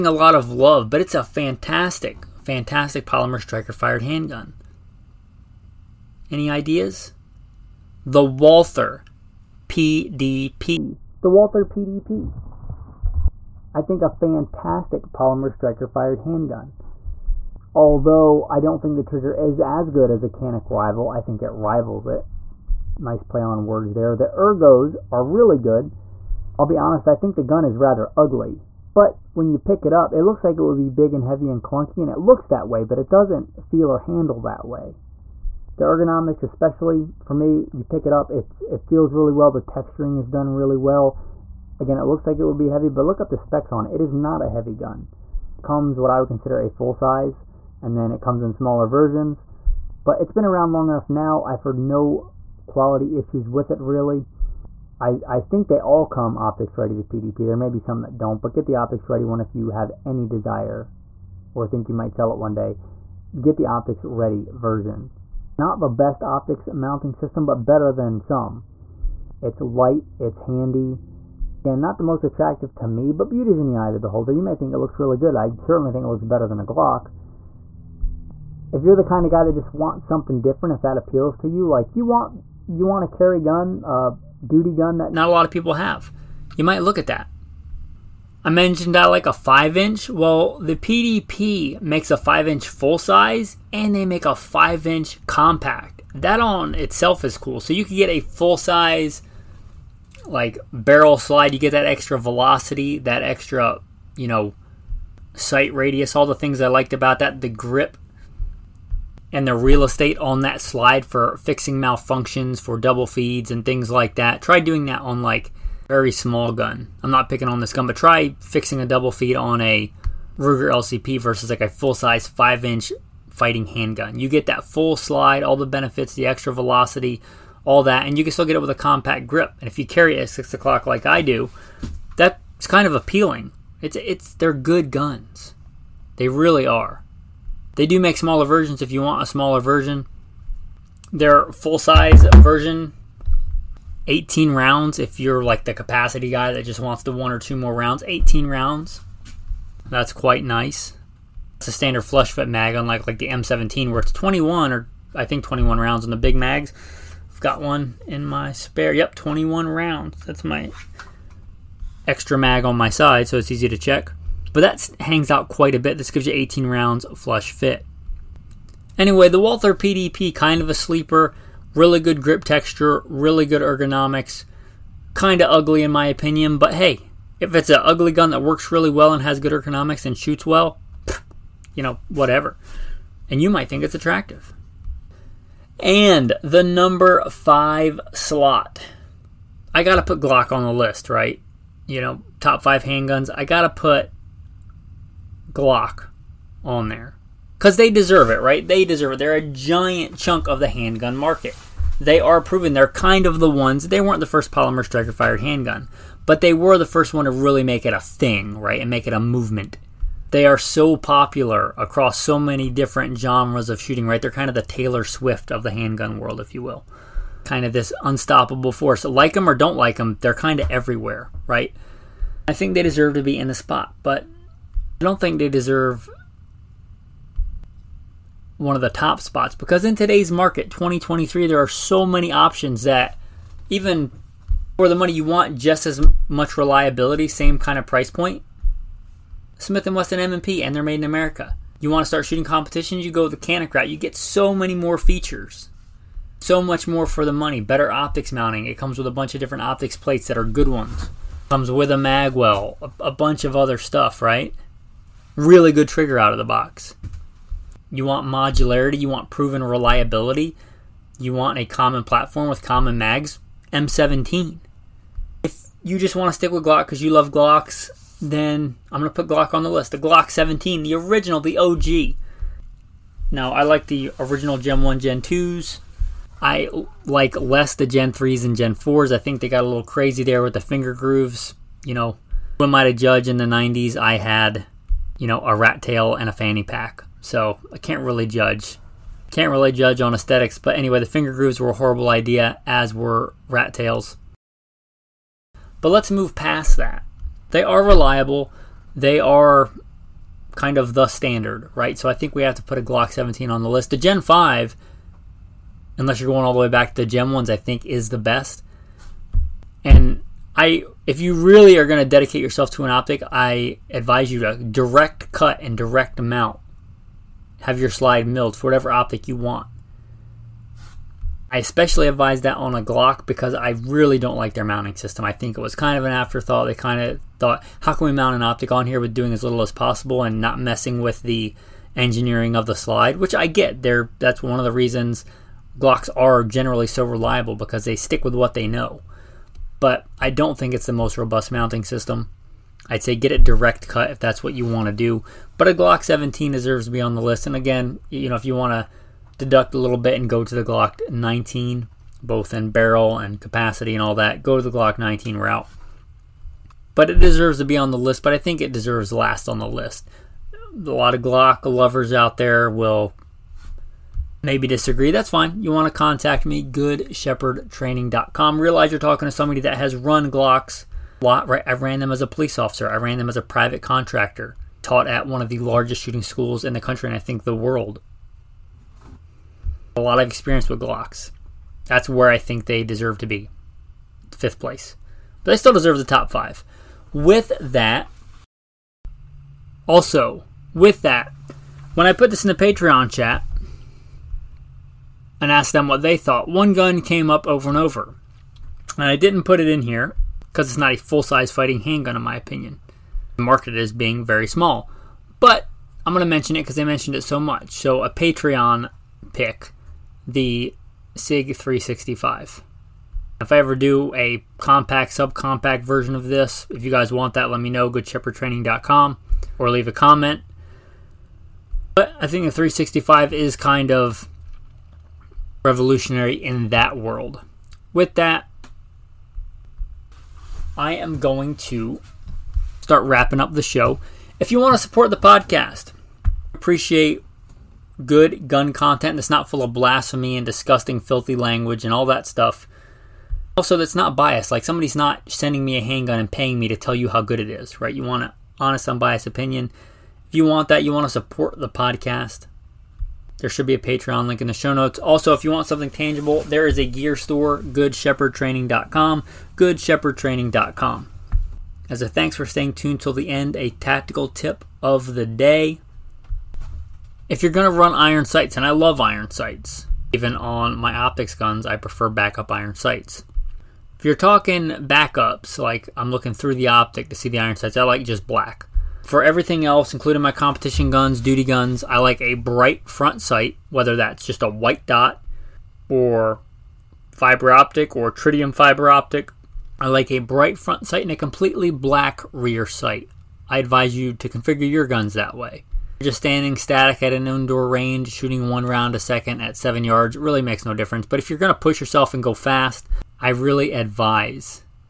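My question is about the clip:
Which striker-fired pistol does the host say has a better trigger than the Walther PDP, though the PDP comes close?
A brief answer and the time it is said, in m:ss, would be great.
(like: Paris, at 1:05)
Canik Rival, at 0:20.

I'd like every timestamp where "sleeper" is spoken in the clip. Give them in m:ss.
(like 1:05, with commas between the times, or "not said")
2:50.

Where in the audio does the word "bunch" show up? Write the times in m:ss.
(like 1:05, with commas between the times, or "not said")
4:09, 4:13.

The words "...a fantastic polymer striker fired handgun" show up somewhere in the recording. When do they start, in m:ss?
0:14.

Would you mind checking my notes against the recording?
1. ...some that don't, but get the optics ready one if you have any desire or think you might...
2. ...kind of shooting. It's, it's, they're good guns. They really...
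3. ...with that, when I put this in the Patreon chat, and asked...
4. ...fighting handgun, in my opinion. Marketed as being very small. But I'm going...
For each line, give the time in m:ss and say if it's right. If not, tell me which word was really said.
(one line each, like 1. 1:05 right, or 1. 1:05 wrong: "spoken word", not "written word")
1. 0:57 right
2. 2:12 wrong: "appealing", not "shooting"
3. 6:30 right
4. 6:41 right.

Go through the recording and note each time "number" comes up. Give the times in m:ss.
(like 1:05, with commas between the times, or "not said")
3:06.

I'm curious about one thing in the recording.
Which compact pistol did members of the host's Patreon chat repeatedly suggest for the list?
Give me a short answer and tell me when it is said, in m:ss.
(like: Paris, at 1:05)
SIG 365, at 6:50.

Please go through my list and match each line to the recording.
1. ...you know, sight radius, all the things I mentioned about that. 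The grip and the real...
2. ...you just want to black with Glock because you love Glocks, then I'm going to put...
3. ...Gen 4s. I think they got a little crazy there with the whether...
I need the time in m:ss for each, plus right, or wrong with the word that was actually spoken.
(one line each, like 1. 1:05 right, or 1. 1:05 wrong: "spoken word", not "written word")
1. 1:44 wrong: "liked", not "mentioned"
2. 4:25 wrong: "stick", not "black"
3. 4:38 wrong: "finger", not "whether".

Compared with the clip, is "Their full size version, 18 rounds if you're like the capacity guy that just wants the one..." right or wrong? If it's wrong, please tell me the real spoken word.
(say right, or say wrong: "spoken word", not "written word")
right.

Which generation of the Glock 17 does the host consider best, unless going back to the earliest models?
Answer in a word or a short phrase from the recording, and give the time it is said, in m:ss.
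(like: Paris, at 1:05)
Gen 5, at 5:03.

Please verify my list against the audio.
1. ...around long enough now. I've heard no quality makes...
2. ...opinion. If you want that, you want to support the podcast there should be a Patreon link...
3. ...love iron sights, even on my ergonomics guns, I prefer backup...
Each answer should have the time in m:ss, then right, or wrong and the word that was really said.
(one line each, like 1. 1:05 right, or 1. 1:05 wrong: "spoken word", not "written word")
1. 0:50 wrong: "issues", not "makes"
2. 7:29 right
3. 7:48 wrong: "optics", not "ergonomics".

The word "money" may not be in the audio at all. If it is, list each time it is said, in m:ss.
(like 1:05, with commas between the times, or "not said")
3:54, 4:07.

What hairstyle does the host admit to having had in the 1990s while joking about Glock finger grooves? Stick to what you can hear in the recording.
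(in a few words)
A rat tail.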